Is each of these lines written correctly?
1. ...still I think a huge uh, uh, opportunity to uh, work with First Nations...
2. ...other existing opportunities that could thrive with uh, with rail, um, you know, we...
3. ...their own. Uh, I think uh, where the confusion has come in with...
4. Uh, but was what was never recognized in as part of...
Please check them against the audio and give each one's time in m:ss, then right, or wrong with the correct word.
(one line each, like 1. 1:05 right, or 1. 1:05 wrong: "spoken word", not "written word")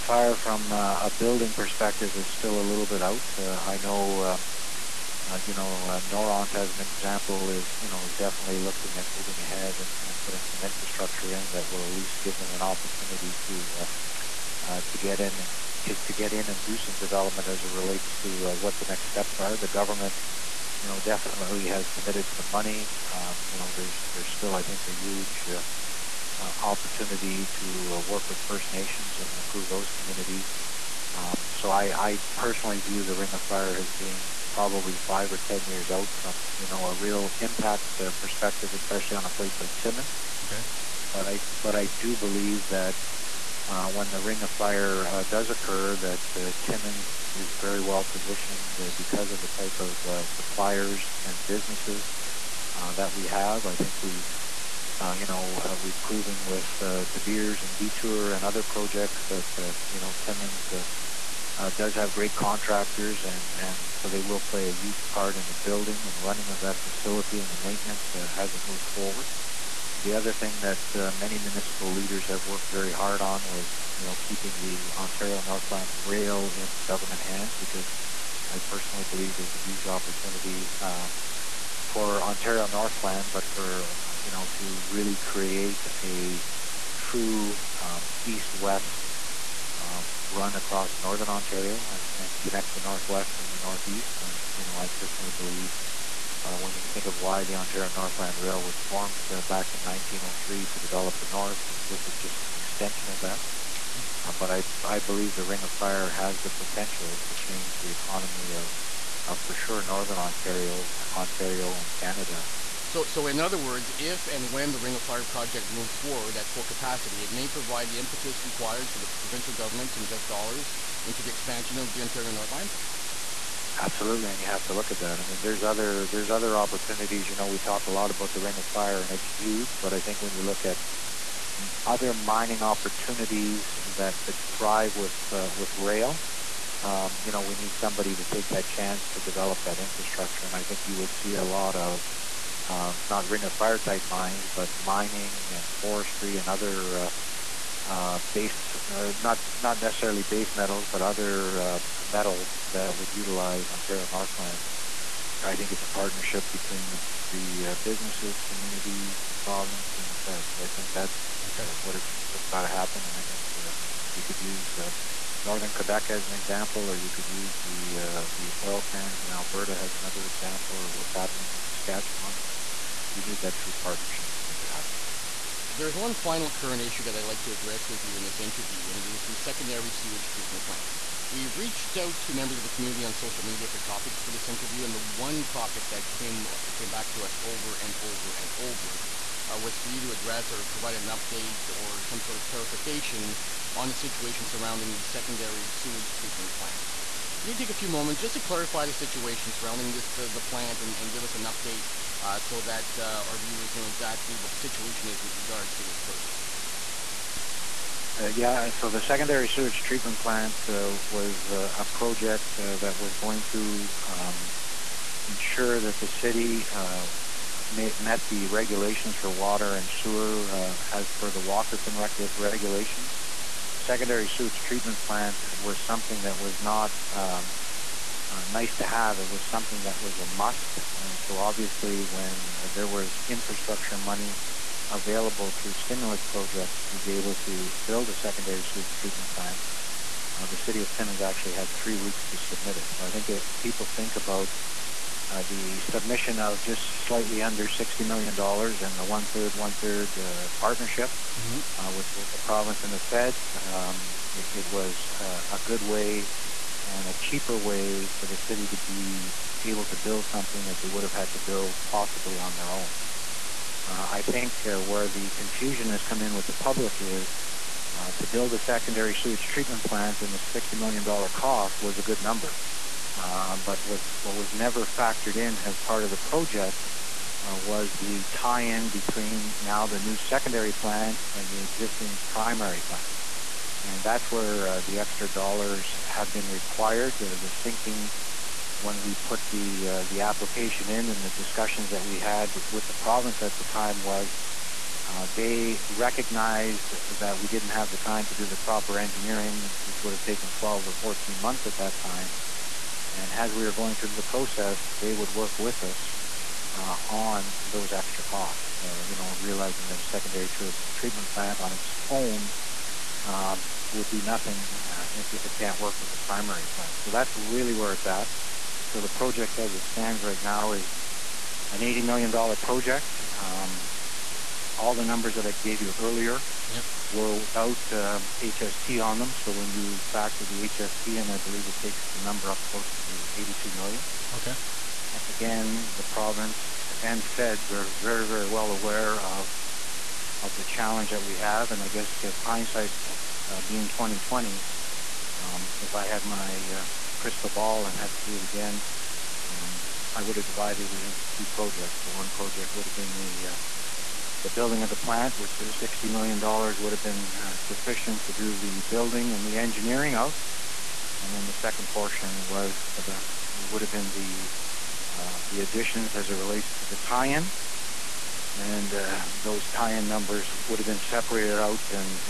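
1. 0:24 right
2. 2:11 wrong: "mining", not "existing"
3. 4:22 right
4. 4:33 wrong: "factored", not "recognized".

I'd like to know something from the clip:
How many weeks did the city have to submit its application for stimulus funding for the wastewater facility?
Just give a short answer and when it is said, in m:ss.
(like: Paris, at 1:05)
3 weeks, at 4:01.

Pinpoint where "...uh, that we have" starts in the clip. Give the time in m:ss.
0:52.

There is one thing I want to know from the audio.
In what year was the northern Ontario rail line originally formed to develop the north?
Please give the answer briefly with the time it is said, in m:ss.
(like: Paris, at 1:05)
1903, at 1:39.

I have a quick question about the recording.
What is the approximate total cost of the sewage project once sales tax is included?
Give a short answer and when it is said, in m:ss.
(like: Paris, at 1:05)
82 million, at 5:33.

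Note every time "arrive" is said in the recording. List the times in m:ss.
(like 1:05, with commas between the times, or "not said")
not said.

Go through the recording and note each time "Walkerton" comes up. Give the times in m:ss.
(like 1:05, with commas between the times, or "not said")
3:41.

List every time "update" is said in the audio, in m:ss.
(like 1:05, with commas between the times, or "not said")
3:11, 3:21.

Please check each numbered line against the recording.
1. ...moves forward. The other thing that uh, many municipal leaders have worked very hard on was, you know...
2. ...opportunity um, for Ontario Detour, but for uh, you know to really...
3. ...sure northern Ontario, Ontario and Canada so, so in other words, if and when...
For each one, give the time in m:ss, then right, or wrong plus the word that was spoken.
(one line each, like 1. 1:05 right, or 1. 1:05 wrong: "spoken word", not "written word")
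1. 1:08 right
2. 1:19 wrong: "Northland", not "Detour"
3. 1:49 right.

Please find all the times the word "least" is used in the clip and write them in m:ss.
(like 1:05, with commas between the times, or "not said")
0:11.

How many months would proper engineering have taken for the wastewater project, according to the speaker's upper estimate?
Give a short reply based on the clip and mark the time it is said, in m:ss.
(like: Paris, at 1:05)
14 months, at 5:00.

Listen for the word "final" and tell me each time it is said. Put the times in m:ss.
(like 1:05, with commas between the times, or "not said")
2:56.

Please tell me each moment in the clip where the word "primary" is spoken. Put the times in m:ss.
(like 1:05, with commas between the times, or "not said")
4:42, 5:16.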